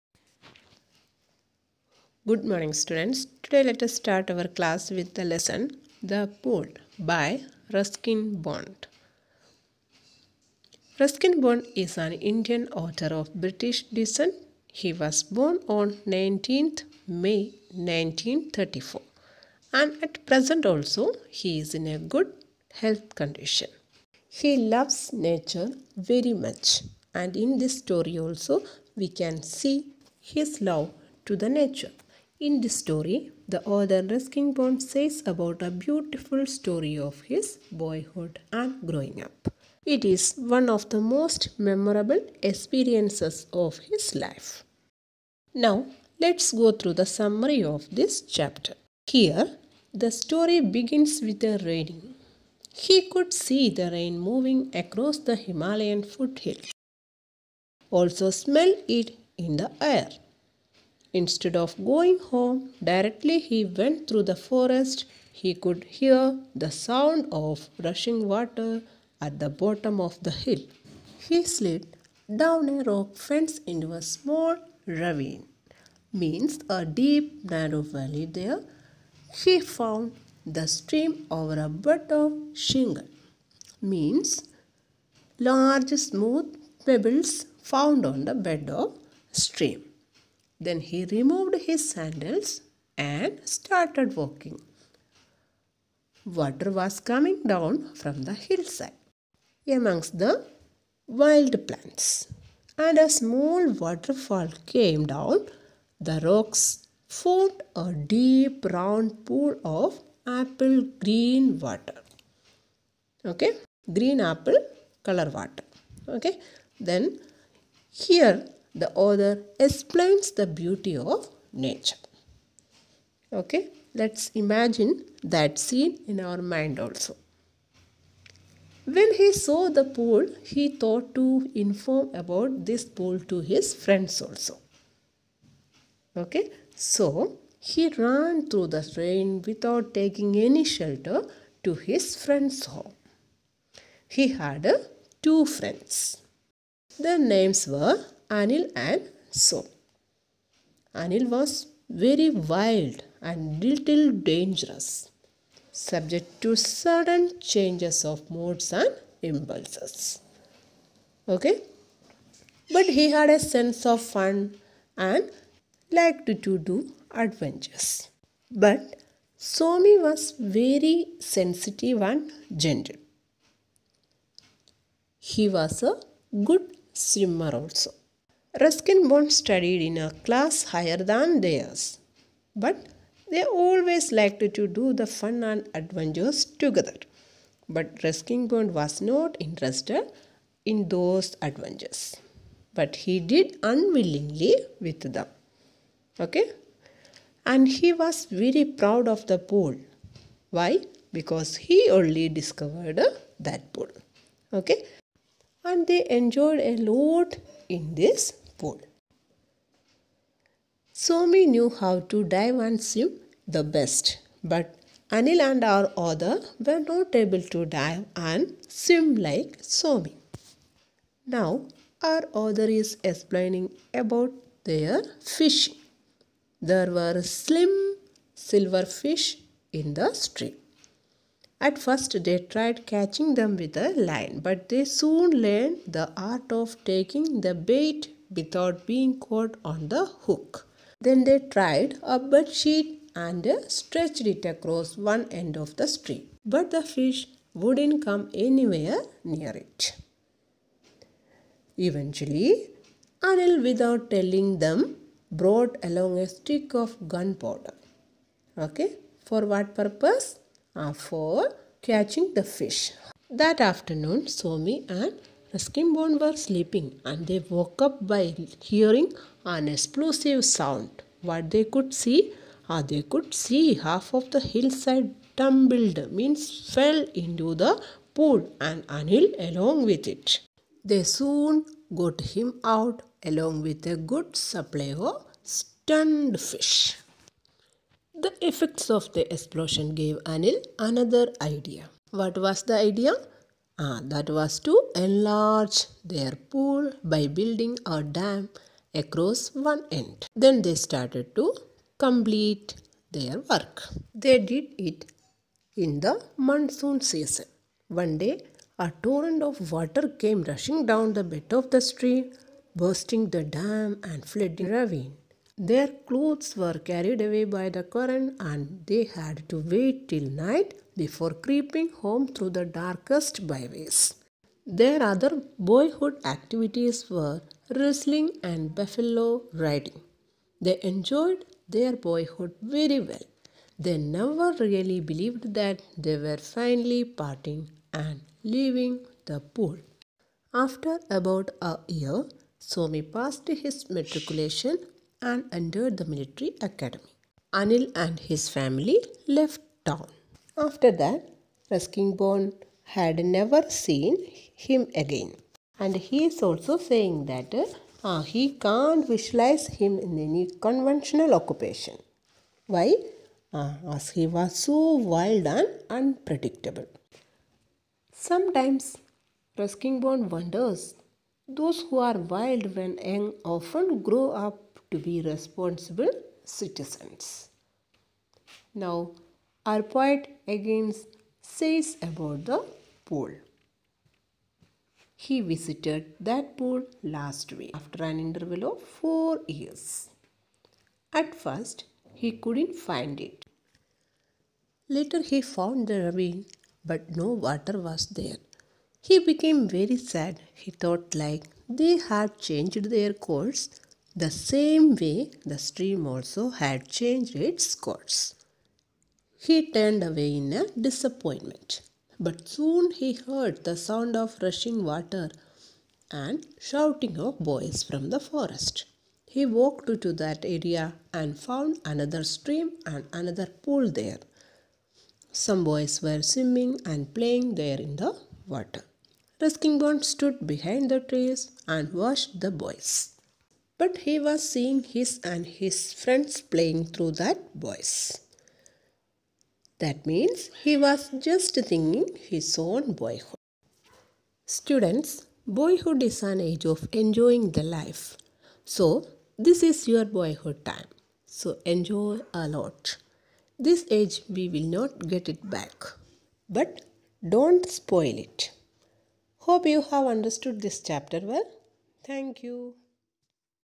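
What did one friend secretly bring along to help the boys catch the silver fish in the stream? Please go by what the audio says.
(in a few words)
A stick of gunpowder.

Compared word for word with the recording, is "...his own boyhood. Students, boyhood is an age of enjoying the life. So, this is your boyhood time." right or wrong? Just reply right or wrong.
right.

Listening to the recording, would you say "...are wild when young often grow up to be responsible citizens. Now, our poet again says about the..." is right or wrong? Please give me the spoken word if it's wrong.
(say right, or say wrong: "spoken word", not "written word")
right.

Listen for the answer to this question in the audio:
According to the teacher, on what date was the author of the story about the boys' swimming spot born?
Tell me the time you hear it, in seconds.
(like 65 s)
16 s.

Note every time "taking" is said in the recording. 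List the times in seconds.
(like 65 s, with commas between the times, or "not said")
139 s, 236 s.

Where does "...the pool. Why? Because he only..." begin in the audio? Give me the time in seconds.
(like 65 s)
199 s.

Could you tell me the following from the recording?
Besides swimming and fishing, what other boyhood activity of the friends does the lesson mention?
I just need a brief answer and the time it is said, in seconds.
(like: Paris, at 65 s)
Buffalo riding, at 328 s.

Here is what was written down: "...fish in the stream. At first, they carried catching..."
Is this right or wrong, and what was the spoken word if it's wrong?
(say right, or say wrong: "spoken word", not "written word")
wrong: "tried", not "carried".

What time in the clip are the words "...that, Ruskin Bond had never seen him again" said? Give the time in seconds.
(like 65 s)
350 s.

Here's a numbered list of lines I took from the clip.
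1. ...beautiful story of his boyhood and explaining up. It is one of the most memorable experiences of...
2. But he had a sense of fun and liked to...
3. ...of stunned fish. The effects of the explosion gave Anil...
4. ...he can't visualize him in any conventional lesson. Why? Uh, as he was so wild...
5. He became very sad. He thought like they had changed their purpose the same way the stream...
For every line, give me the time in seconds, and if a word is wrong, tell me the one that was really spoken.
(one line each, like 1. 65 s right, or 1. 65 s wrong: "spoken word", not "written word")
1. 35 s wrong: "growing", not "explaining"
2. 162 s right
3. 285 s right
4. 358 s wrong: "occupation", not "lesson"
5. 399 s wrong: "course", not "purpose".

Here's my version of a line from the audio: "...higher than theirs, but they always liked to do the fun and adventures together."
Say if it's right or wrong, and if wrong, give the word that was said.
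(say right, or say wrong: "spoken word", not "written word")
right.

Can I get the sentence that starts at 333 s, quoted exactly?
They never really believed that they were finally parting and leaving the pool.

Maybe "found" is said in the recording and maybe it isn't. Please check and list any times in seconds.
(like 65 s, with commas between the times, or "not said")
79 s, 87 s, 395 s, 421 s.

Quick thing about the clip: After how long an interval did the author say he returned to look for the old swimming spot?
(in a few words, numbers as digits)
4 years.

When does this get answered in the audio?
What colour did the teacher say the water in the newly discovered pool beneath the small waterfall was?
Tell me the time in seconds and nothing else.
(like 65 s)
110 s.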